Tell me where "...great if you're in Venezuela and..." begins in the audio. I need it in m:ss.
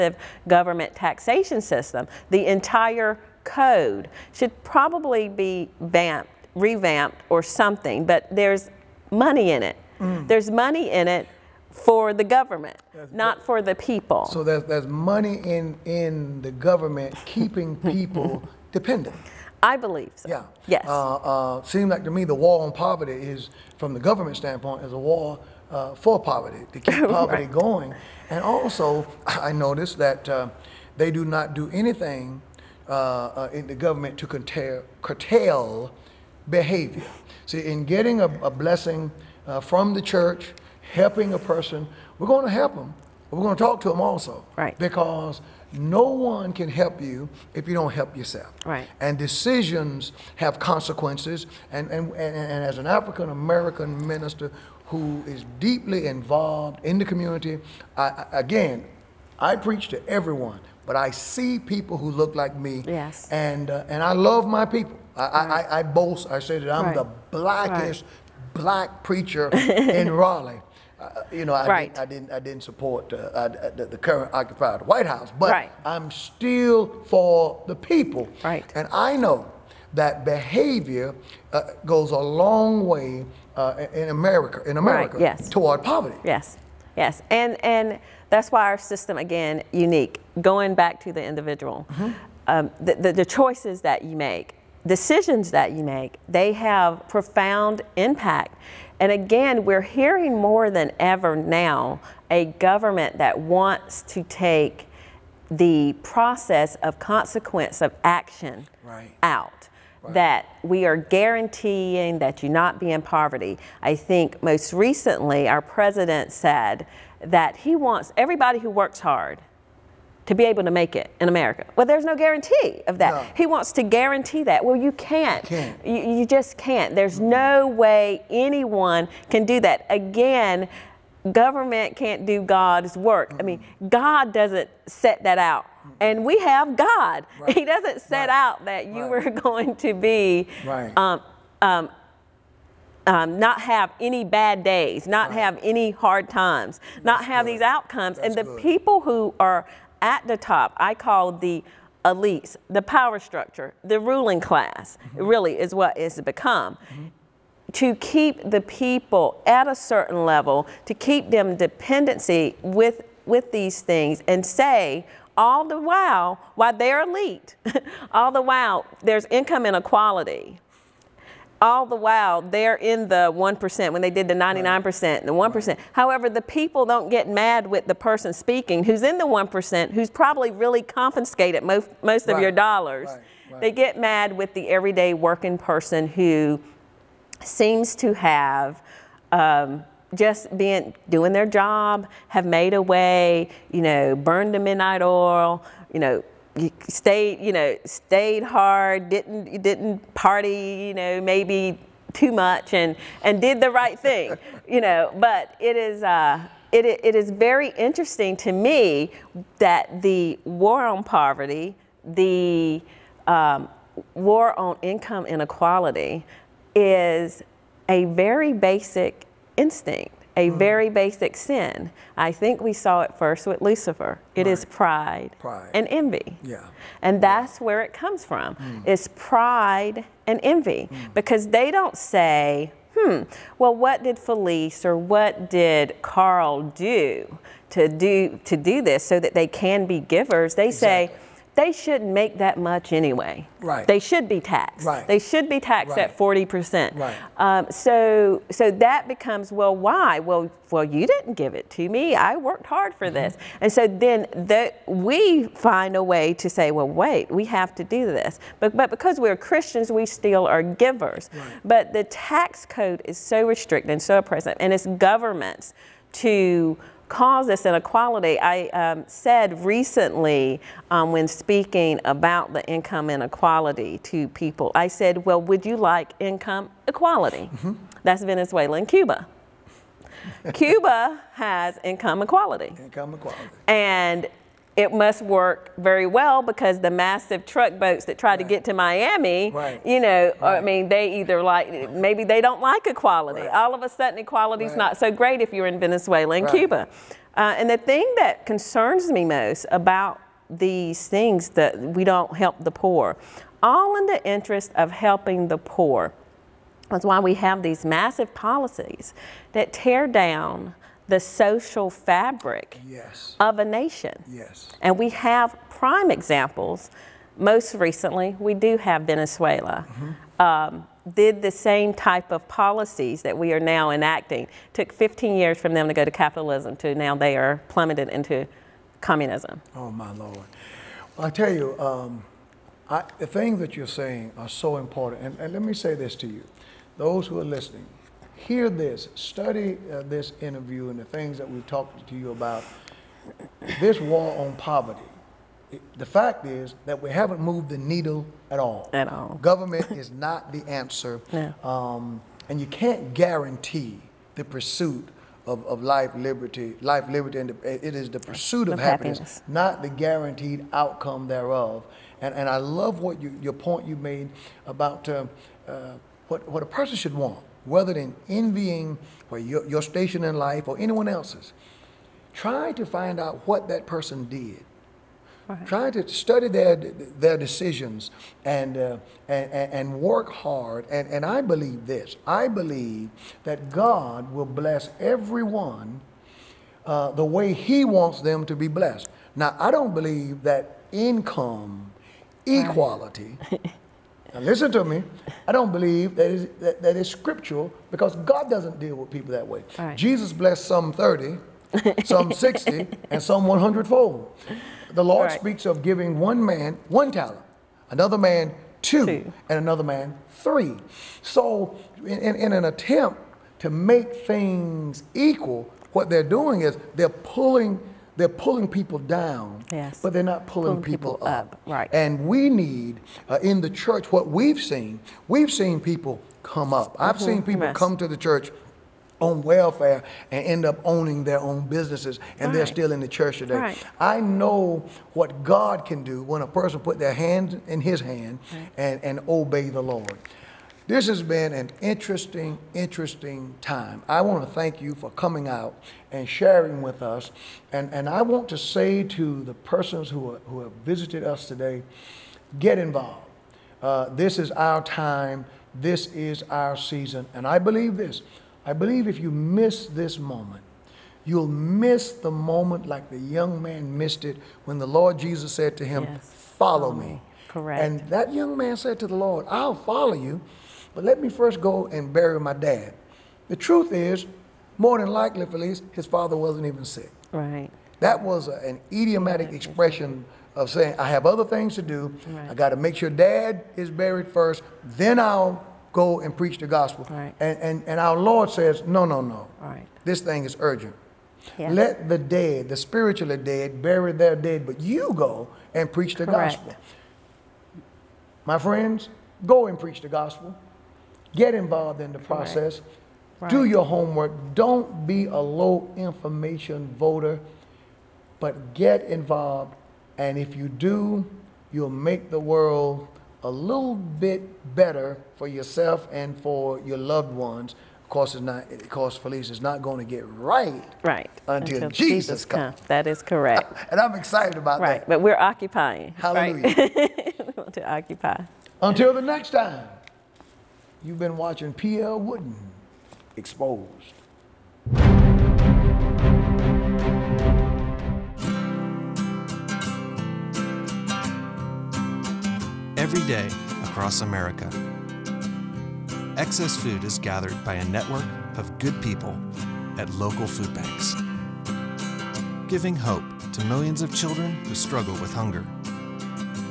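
4:55.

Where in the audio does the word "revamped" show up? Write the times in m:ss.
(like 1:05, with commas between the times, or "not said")
0:06.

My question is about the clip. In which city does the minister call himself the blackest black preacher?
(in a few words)
Raleigh.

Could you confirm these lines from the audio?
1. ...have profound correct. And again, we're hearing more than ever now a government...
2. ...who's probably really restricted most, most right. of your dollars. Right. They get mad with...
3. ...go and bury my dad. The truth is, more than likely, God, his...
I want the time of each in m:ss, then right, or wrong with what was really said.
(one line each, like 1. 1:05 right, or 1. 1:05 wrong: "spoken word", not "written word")
1. 1:36 wrong: "impact", not "correct"
2. 2:59 wrong: "confiscated", not "restricted"
3. 7:51 wrong: "Felice", not "God".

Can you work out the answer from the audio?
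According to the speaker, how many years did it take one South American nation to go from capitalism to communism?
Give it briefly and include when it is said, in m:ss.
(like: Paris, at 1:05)
15 years, at 5:24.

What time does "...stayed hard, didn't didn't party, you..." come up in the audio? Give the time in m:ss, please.
3:17.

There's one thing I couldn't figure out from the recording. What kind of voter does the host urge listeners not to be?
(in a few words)
low information voter.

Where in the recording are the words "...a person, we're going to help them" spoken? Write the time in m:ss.
0:41.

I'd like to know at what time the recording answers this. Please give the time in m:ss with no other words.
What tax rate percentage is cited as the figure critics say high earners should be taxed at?
4:06.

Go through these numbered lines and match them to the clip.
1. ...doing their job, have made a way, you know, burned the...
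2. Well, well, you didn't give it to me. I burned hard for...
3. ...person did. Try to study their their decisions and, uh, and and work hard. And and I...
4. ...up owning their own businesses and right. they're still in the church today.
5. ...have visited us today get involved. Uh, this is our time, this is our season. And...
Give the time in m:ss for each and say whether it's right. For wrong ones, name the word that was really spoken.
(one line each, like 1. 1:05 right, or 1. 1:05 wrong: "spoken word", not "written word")
1. 3:11 right
2. 4:10 wrong: "worked", not "burned"
3. 6:13 right
4. 7:10 right
5. 7:30 right.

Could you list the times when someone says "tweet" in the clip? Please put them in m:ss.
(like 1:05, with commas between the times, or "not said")
not said.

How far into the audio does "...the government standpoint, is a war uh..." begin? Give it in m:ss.
0:23.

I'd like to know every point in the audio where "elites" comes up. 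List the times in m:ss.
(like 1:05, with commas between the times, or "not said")
2:32, 2:47.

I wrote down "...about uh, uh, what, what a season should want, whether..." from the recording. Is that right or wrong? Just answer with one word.
wrong.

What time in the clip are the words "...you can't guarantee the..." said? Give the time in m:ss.
5:52.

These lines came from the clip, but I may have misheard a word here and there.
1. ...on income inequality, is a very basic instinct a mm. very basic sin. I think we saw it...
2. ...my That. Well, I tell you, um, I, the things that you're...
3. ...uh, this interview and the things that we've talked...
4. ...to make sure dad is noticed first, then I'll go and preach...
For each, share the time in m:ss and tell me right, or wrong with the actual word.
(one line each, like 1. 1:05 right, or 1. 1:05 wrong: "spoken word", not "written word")
1. 3:34 right
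2. 5:29 wrong: "Lord", not "That"
3. 5:39 right
4. 8:02 wrong: "buried", not "noticed".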